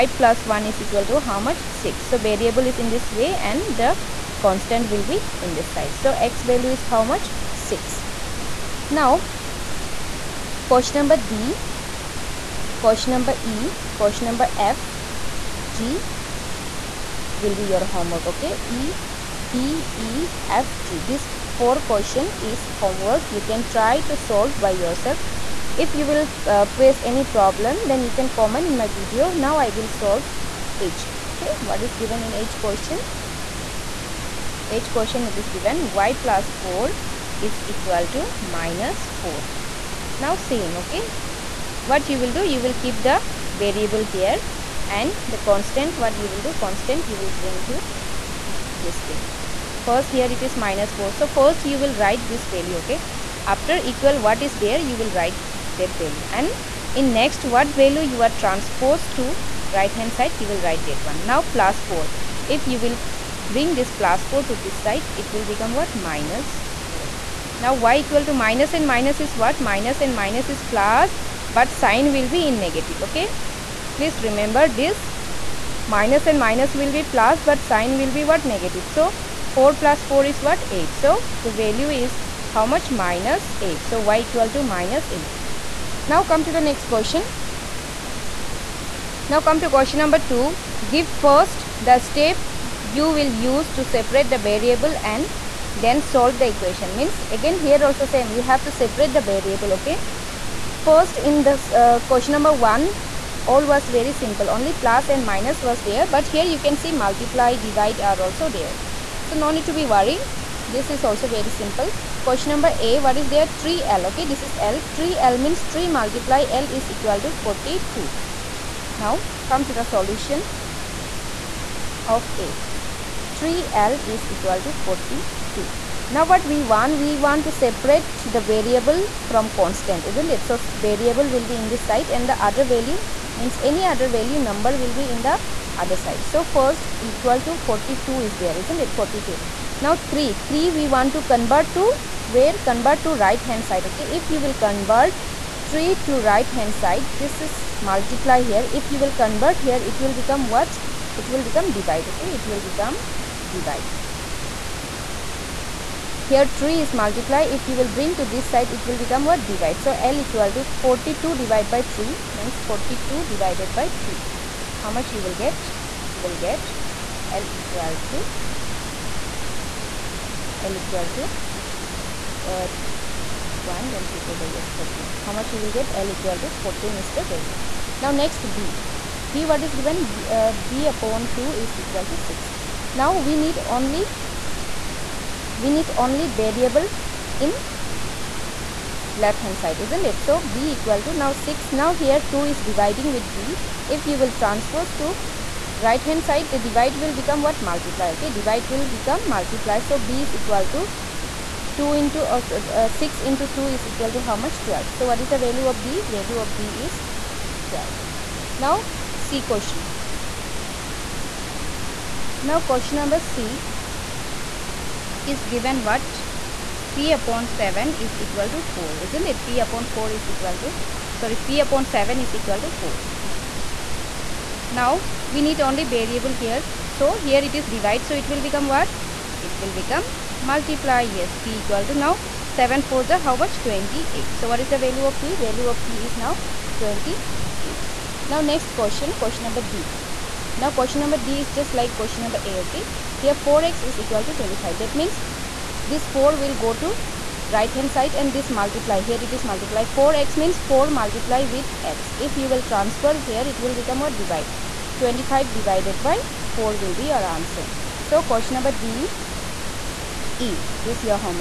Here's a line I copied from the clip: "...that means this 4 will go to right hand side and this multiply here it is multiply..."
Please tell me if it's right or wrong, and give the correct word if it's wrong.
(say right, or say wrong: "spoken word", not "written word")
right.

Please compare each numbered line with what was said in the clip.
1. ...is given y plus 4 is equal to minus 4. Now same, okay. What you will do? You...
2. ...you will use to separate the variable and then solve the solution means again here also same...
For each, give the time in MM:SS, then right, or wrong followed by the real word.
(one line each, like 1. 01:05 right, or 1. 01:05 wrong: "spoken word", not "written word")
1. 00:35 right
2. 01:32 wrong: "equation", not "solution".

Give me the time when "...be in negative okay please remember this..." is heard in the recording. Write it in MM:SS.
01:12.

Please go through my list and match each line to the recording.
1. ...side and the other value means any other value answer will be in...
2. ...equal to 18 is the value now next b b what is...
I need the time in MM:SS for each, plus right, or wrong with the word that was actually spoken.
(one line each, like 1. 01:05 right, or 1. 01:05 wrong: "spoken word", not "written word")
1. 02:11 wrong: "number", not "answer"
2. 02:56 wrong: "14", not "18".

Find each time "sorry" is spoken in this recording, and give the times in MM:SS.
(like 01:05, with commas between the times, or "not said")
03:41.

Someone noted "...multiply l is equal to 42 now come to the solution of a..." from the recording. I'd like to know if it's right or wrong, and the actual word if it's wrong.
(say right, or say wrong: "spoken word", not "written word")
right.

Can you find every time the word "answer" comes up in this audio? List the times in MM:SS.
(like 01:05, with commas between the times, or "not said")
04:17.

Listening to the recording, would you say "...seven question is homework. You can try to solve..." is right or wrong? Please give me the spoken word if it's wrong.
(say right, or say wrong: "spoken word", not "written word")
wrong: "four", not "seven".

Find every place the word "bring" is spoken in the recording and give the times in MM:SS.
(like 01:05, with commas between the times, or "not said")
00:47, 01:03, 02:37.